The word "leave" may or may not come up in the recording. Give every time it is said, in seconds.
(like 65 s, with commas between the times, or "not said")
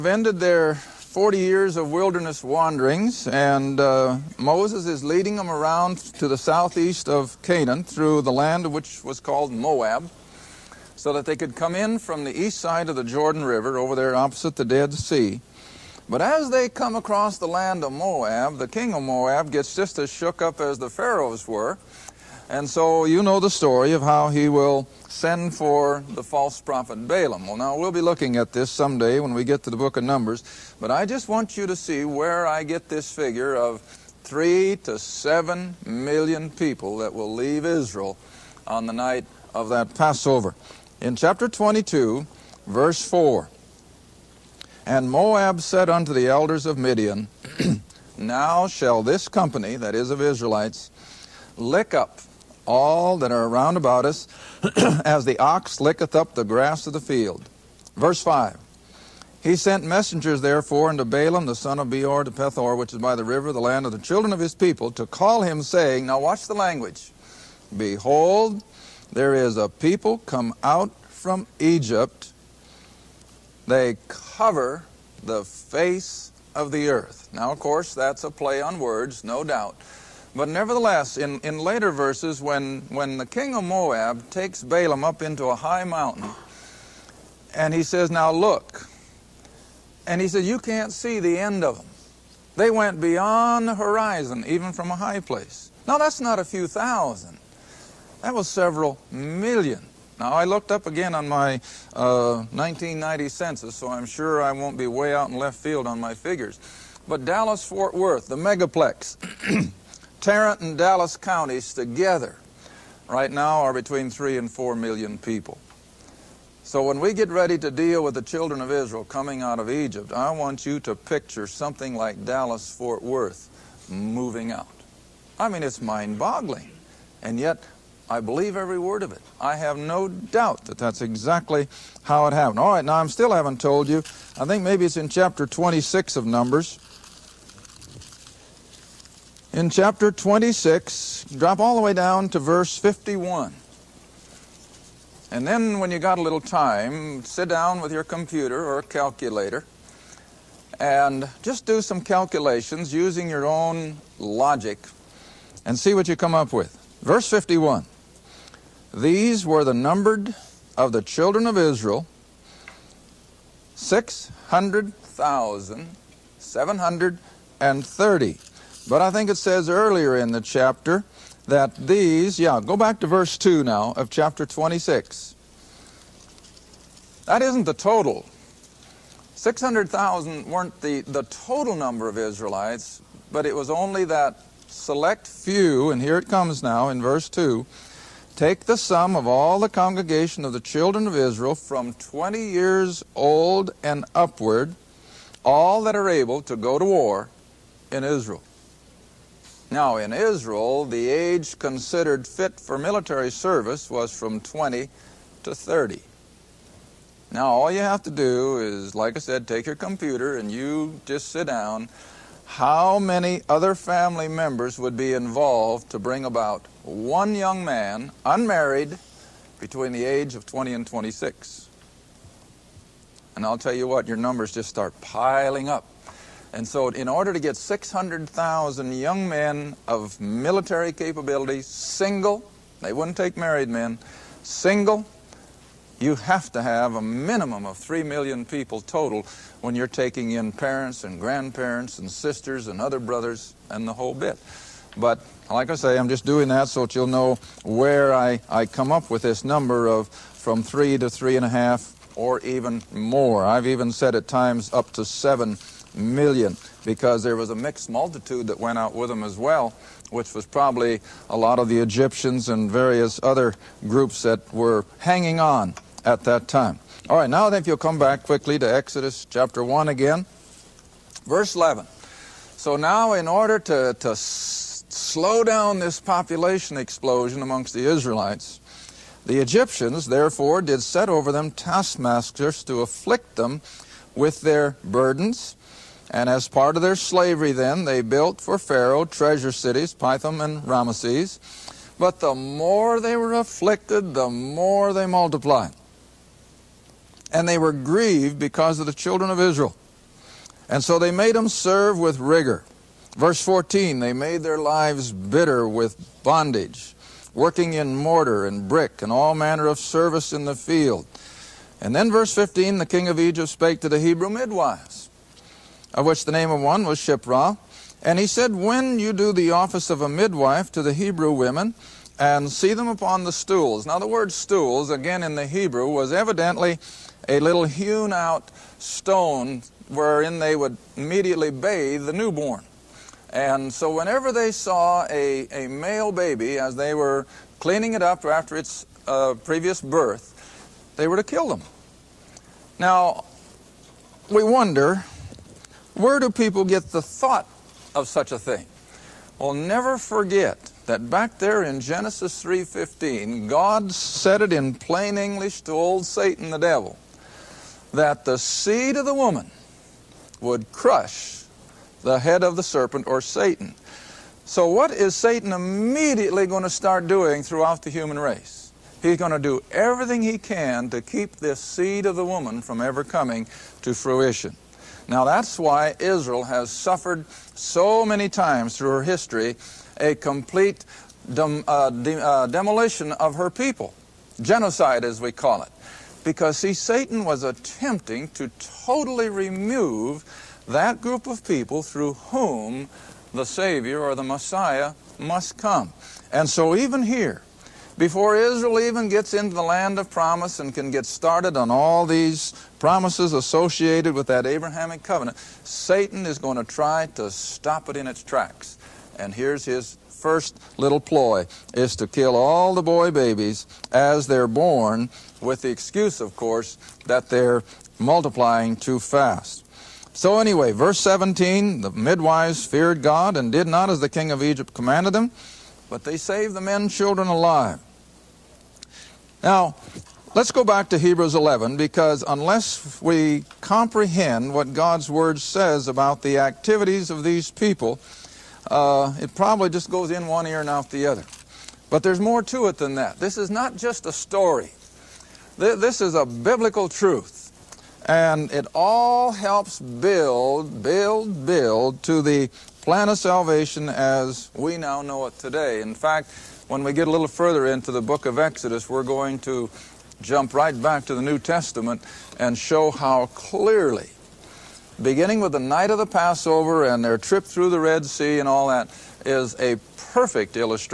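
37 s.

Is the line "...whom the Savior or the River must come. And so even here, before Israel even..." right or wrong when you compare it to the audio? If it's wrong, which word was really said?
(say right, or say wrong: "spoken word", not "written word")
wrong: "Messiah", not "River".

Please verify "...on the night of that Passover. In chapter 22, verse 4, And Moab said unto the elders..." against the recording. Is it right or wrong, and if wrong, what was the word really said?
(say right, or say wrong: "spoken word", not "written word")
right.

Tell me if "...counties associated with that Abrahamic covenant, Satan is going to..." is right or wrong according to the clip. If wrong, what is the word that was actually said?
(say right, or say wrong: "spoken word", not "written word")
wrong: "promises", not "counties".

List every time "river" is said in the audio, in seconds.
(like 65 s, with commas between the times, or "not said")
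13 s, 63 s.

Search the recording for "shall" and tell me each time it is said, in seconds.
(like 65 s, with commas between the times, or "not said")
48 s.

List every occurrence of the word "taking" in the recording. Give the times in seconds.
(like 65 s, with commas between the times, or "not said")
239 s.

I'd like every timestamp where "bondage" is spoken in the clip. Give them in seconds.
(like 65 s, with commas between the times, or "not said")
306 s.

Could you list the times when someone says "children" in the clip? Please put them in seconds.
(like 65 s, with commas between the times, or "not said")
63 s, 118 s, 161 s, 190 s, 298 s, 426 s.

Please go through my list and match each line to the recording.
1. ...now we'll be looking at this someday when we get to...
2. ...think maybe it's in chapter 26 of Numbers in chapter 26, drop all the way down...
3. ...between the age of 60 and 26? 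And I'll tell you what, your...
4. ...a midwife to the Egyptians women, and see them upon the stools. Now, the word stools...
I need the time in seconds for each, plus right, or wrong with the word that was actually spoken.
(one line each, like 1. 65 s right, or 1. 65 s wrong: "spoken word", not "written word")
1. 27 s right
2. 134 s right
3. 219 s wrong: "20", not "60"
4. 320 s wrong: "Hebrew", not "Egyptians".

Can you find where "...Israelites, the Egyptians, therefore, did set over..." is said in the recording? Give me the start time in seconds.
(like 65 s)
277 s.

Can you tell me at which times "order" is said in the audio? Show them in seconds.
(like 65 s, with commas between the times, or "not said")
227 s, 273 s.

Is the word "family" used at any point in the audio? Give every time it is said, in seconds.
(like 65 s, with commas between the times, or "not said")
213 s.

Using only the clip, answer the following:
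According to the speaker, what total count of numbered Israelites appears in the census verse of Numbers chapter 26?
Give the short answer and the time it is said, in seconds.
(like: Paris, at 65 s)
600,730, at 163 s.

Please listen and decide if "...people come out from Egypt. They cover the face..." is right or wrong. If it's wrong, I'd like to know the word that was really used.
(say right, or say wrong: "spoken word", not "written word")
right.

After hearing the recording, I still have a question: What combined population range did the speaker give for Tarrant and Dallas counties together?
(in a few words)
3 to 4 million.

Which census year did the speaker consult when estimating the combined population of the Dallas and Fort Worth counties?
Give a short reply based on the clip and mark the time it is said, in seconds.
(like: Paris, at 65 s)
1990, at 102 s.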